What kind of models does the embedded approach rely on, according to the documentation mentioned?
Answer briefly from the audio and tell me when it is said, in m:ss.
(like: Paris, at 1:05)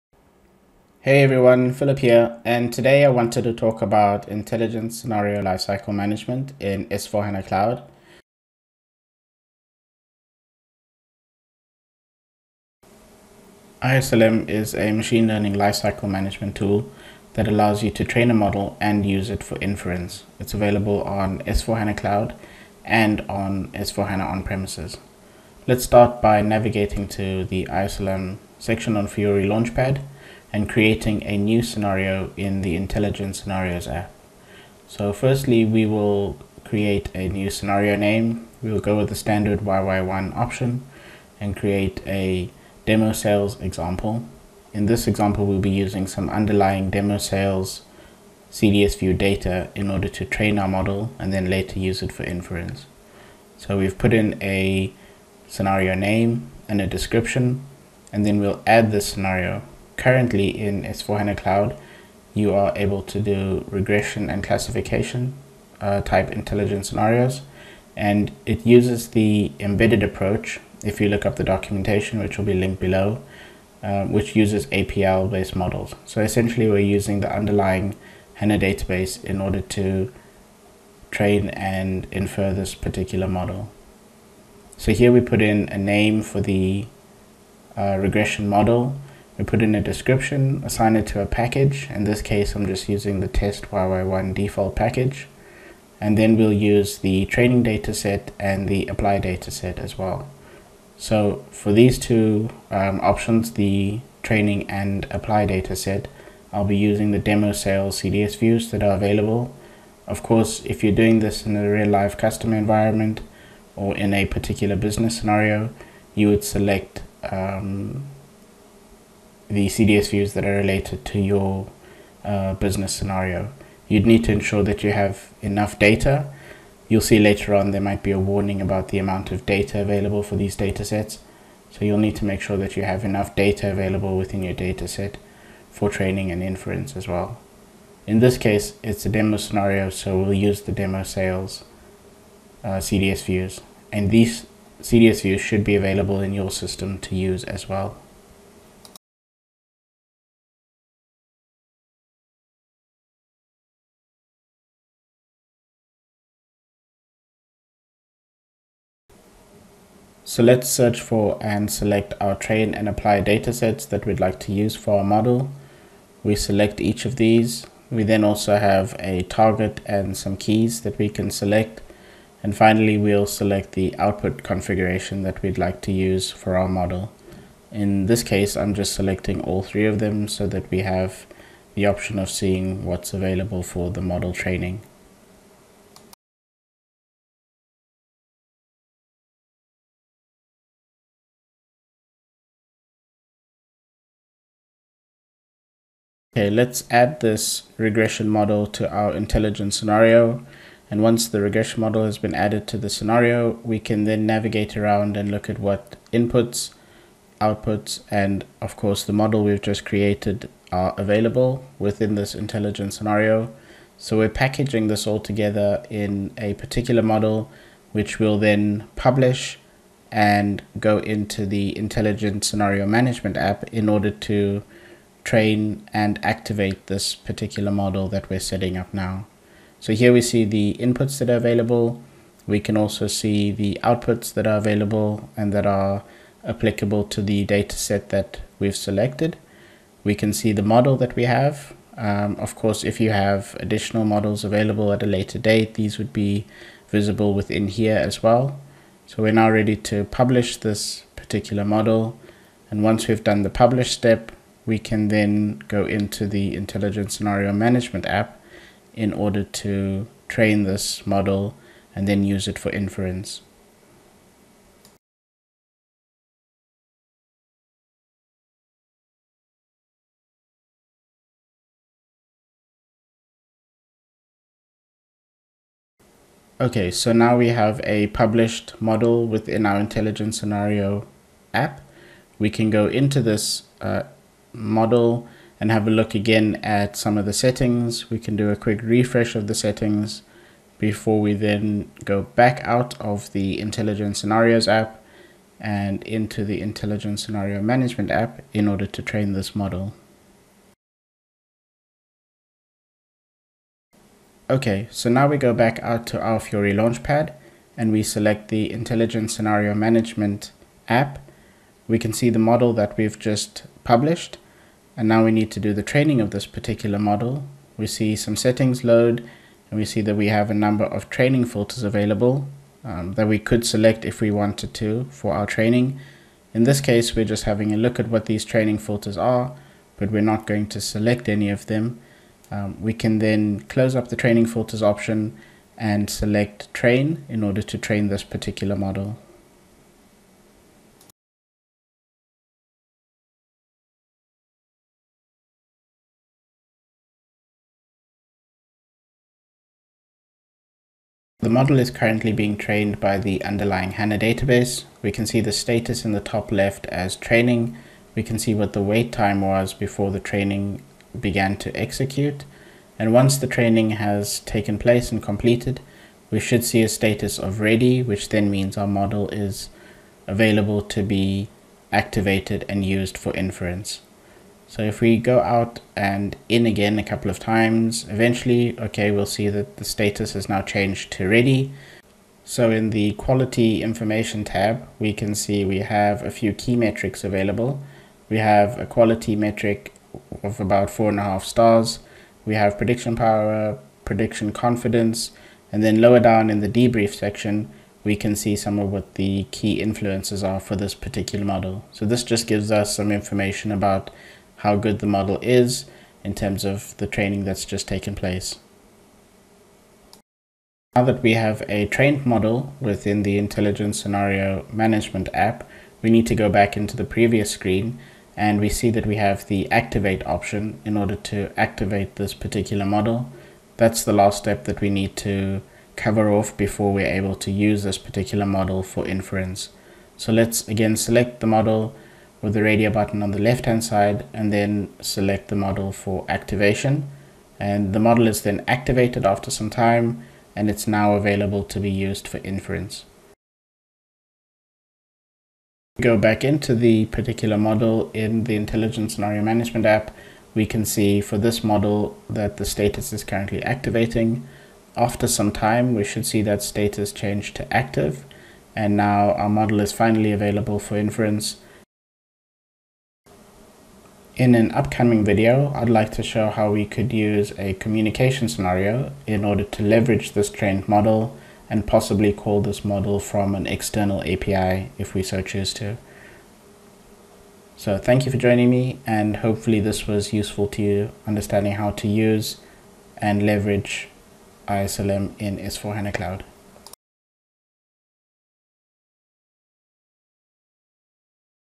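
APL-based models, at 1:14.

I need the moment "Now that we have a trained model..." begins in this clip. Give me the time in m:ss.
6:50.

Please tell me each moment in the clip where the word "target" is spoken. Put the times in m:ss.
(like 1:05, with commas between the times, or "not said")
2:49.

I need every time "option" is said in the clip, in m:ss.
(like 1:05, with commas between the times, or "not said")
0:40, 1:43, 3:01, 5:34, 7:00.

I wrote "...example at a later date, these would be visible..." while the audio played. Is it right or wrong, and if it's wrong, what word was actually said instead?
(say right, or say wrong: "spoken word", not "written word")
wrong: "available", not "example".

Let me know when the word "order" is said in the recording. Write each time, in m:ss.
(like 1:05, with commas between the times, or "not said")
0:49, 1:19, 3:43, 4:19, 4:58, 5:37, 7:00, 7:49.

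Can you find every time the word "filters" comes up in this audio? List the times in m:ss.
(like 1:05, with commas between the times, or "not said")
5:21, 5:28, 5:34.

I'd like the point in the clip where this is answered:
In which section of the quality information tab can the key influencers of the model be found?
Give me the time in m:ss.
6:36.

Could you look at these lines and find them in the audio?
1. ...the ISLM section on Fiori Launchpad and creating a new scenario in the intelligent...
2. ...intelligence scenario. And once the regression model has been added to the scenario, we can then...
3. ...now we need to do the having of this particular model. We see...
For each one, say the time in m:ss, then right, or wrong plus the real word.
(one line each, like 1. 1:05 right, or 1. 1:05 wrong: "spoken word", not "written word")
1. 0:27 right
2. 3:19 right
3. 5:15 wrong: "training", not "having".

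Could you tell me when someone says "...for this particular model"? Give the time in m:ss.
6:40.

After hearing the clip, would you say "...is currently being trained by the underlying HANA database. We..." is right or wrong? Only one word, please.
right.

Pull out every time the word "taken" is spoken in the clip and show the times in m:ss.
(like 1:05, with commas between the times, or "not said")
6:04, 6:47.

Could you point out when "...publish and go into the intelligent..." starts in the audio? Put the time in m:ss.
3:38.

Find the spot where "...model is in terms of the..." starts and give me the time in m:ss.
6:45.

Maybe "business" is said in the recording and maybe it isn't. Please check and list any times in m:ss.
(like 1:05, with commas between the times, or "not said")
1:54, 2:02.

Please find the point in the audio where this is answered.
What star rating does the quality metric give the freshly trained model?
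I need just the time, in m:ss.
6:30.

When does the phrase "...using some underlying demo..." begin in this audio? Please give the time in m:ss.
0:45.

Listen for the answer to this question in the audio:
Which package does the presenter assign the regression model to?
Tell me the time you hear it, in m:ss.
1:33.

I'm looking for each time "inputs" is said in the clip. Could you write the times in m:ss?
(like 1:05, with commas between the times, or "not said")
3:26, 3:50.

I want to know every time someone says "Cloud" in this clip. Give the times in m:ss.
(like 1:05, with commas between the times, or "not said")
0:07, 0:21, 1:01, 8:06.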